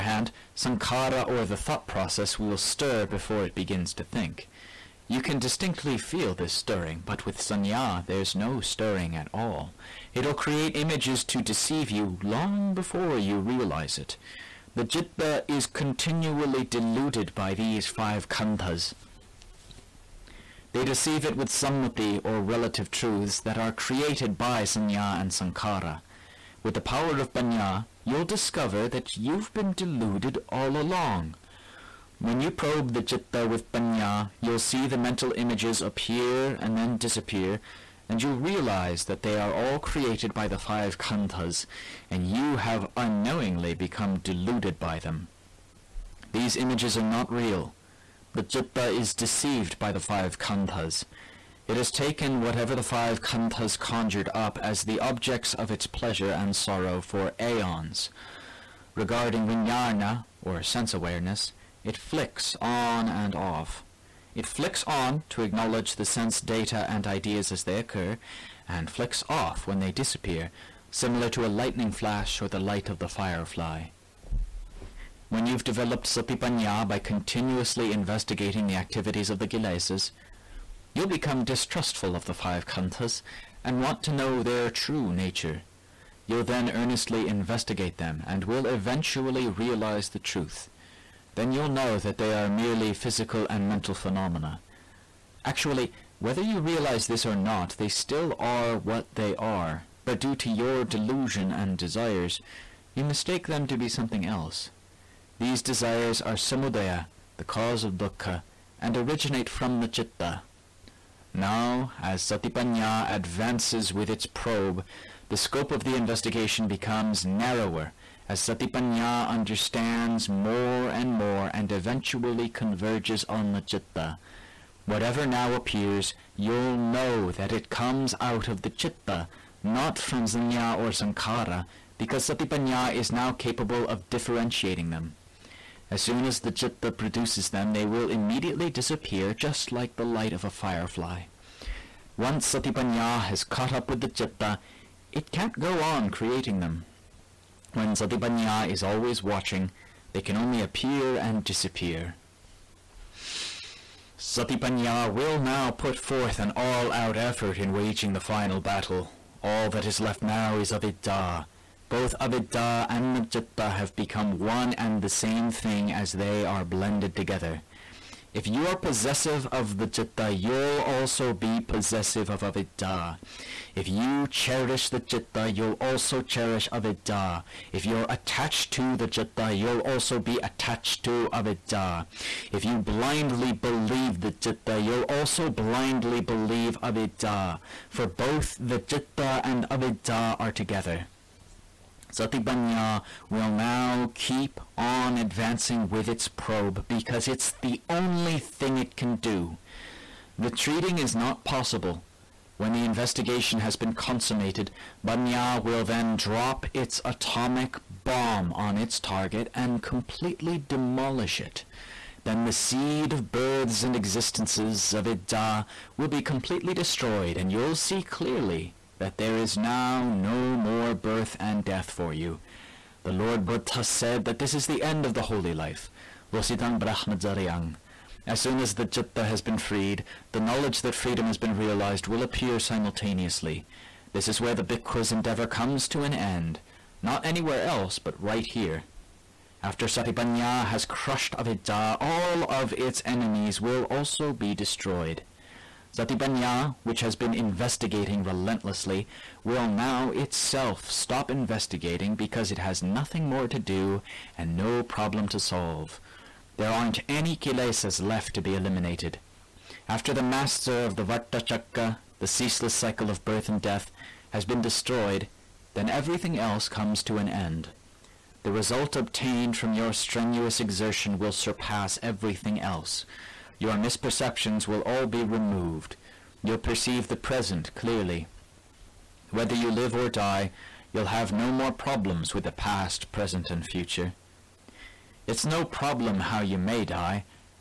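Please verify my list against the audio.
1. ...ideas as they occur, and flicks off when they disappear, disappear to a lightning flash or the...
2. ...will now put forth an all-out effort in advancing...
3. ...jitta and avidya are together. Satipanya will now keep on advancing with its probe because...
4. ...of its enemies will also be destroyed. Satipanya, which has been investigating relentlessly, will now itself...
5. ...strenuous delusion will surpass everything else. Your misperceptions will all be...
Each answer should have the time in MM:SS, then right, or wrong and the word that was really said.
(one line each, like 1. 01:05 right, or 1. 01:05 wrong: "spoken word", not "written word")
1. 01:07 wrong: "similar", not "disappear"
2. 02:35 wrong: "waging", not "advancing"
3. 03:08 right
4. 04:02 right
5. 04:29 wrong: "exertion", not "delusion".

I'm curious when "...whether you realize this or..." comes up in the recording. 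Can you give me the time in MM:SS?
01:36.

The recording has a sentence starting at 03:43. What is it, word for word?
The Lord Buddha said that this is the end of the holy life.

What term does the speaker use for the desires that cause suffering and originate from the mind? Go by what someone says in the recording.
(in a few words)
samudaya.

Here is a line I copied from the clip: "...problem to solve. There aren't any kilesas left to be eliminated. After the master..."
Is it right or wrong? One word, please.
right.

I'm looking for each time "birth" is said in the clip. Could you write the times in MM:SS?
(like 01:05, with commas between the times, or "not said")
03:33, 03:40, 04:23.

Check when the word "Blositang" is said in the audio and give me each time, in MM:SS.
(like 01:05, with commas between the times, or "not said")
03:46.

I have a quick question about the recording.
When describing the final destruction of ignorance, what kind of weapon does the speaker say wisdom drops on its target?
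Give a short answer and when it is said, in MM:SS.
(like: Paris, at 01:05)
atomic bomb, at 03:27.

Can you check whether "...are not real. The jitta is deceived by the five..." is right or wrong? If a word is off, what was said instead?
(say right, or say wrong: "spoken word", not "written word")
right.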